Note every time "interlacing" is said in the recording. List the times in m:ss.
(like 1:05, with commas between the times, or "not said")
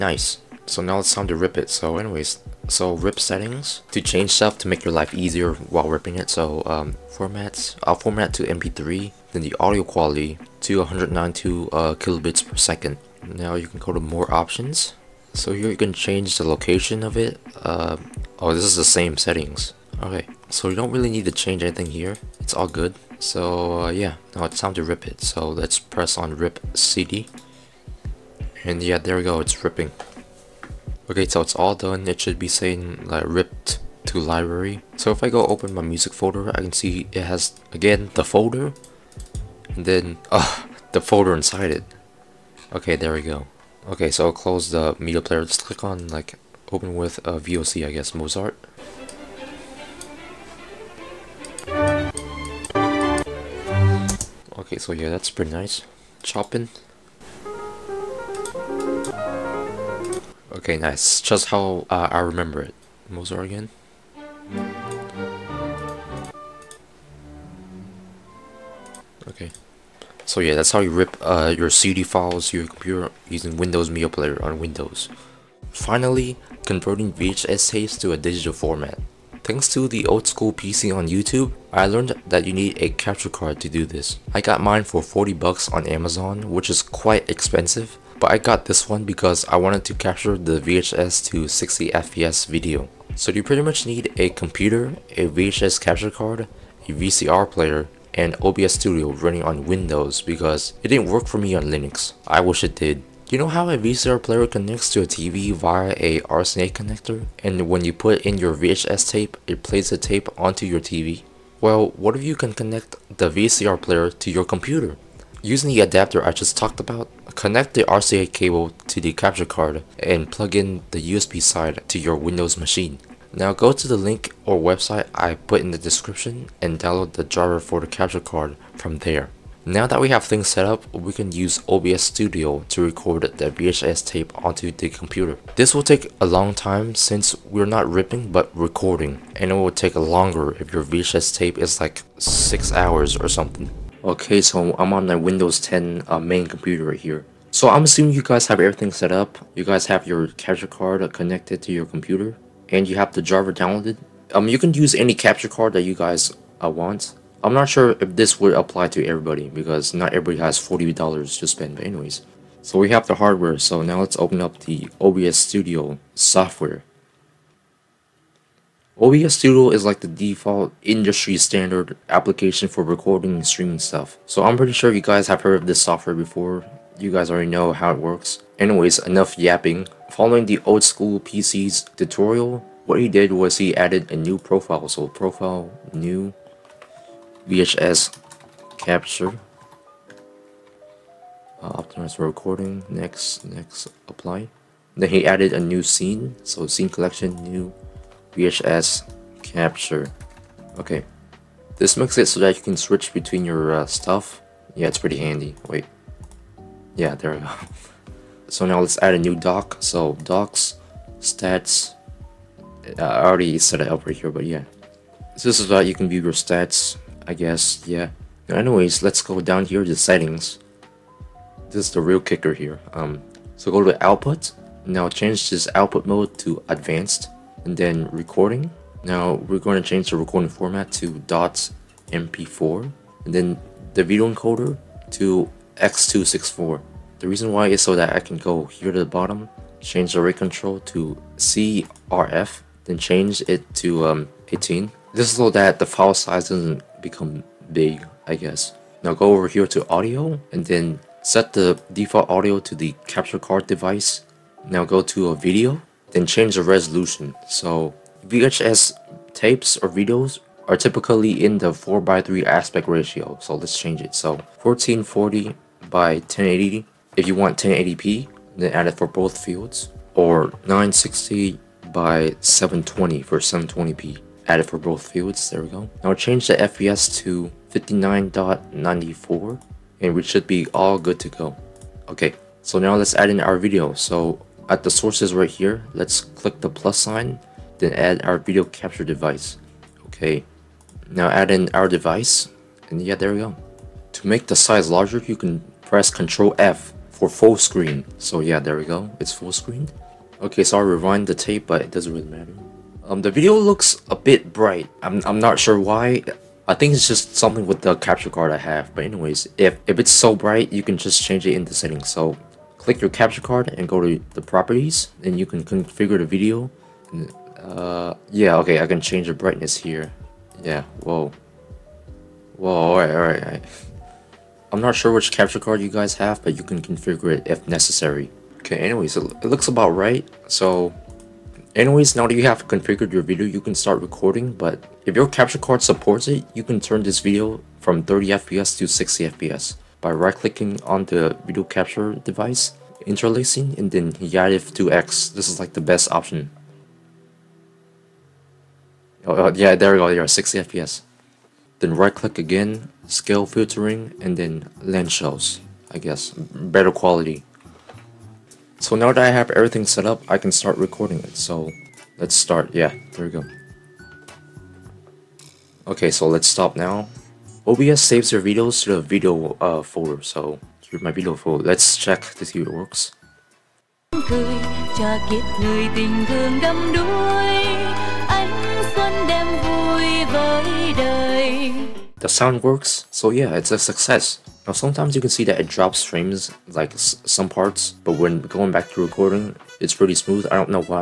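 5:43.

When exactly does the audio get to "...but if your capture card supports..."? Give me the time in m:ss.
5:34.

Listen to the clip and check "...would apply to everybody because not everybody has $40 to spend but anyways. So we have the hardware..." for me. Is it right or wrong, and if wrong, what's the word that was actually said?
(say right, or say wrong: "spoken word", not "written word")
right.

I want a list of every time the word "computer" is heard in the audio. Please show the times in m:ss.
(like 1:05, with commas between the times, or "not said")
1:12, 1:34, 1:54, 2:14, 2:26, 2:31.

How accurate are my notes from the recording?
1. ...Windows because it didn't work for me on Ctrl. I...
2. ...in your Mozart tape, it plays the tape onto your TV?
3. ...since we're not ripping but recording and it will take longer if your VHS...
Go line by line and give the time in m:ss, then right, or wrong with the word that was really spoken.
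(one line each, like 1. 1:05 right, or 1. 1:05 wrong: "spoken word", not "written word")
1. 1:39 wrong: "Linux", not "Ctrl"
2. 1:48 wrong: "VHS", not "Mozart"
3. 2:16 right.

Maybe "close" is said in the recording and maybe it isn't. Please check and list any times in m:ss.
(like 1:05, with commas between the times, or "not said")
0:44.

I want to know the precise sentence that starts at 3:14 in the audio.
Then he added a new scene.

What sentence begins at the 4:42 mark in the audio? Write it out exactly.
Okay, so now let's add in our video.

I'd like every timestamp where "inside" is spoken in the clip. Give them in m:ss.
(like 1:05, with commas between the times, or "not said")
0:41.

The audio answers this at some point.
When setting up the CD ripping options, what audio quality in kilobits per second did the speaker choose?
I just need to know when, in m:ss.
0:10.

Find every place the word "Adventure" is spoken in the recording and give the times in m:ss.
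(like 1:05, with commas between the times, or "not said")
not said.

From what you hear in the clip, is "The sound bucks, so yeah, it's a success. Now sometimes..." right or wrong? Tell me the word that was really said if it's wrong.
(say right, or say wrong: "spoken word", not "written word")
wrong: "works", not "bucks".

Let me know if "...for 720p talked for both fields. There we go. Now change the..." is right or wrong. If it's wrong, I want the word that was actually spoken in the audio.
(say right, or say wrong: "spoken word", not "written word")
wrong: "added", not "talked".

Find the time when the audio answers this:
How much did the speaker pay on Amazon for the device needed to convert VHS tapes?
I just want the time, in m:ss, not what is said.
1:25.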